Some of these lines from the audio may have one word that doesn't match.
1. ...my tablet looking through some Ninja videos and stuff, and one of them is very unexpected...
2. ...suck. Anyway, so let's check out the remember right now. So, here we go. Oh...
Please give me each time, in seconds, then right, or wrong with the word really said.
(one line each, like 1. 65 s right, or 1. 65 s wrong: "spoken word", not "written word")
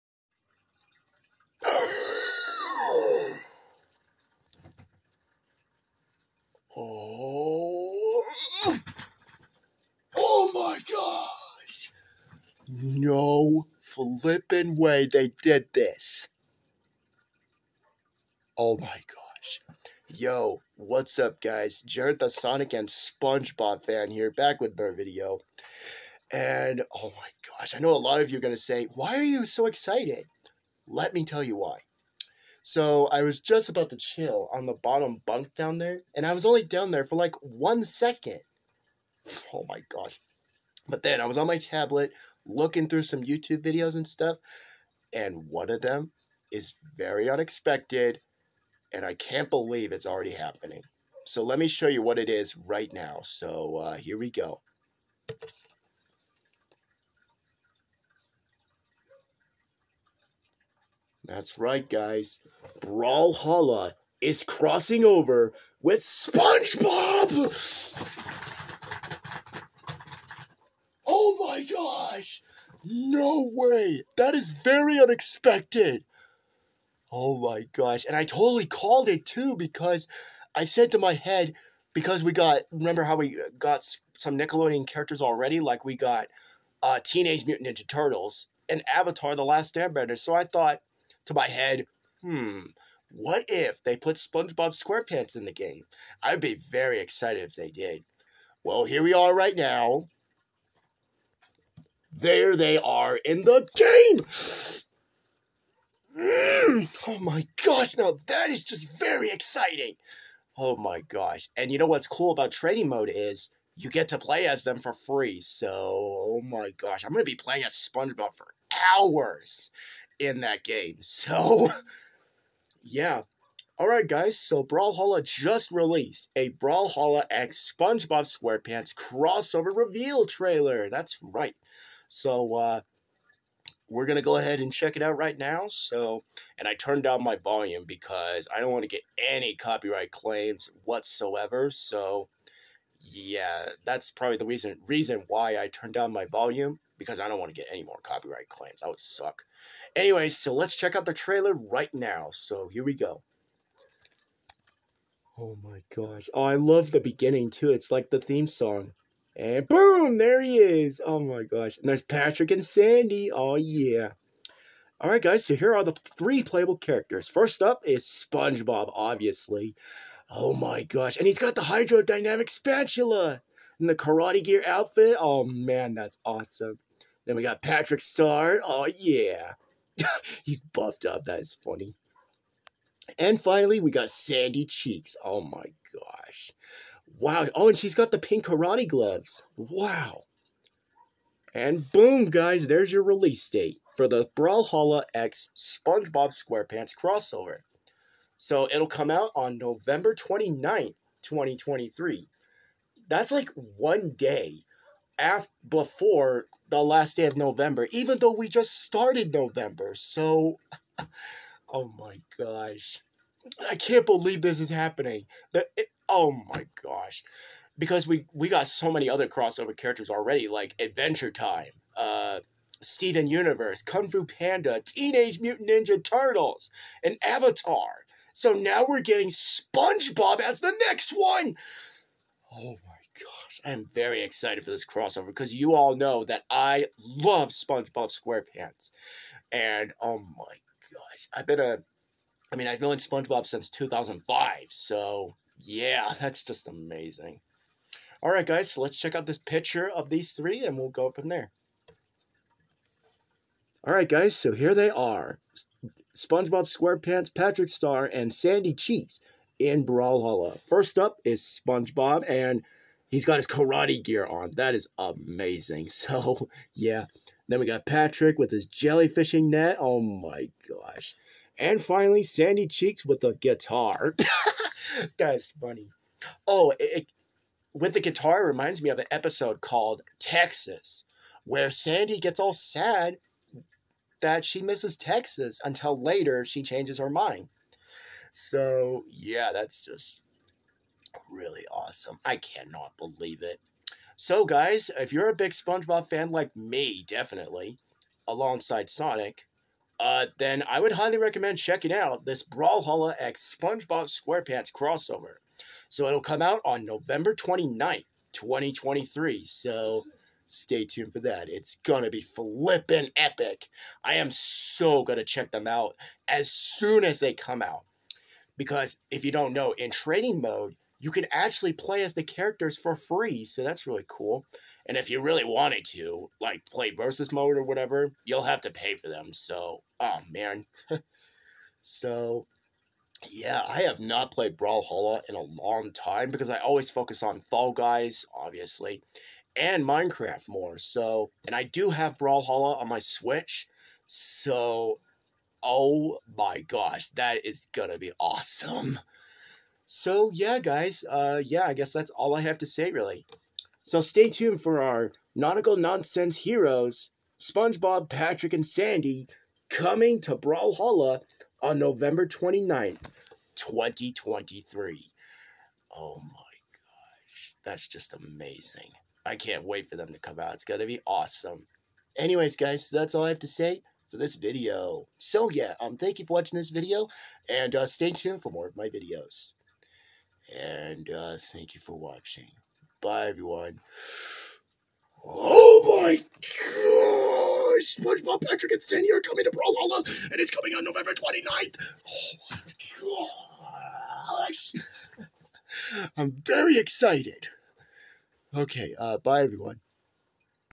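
1. 41 s wrong: "YouTube", not "Ninja"
2. 148 s wrong: "trailer", not "remember".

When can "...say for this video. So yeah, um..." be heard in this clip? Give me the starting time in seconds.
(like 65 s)
373 s.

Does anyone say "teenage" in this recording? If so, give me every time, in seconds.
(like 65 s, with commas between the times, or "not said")
87 s, 224 s.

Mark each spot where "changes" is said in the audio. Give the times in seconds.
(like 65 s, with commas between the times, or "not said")
286 s.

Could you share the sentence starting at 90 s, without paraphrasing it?
So I thought to my head, hmm, what if they put SpongeBob SquarePants in the game?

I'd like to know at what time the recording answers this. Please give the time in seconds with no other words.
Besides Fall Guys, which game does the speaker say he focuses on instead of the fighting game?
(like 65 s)
339 s.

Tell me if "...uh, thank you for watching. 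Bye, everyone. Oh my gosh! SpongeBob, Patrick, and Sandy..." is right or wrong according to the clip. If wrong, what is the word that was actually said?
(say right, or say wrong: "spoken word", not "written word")
right.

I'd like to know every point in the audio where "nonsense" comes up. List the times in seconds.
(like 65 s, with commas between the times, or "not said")
355 s.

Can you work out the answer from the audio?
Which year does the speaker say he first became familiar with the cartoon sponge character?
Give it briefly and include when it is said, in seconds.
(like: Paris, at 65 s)
2005, at 243 s.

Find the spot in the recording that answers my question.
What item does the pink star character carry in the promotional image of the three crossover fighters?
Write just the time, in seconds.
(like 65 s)
268 s.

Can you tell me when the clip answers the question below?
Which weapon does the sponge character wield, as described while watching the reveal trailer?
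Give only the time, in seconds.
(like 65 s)
171 s.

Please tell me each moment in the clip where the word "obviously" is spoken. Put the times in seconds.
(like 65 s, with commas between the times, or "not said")
168 s, 338 s.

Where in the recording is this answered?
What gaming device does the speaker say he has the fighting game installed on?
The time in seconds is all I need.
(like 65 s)
342 s.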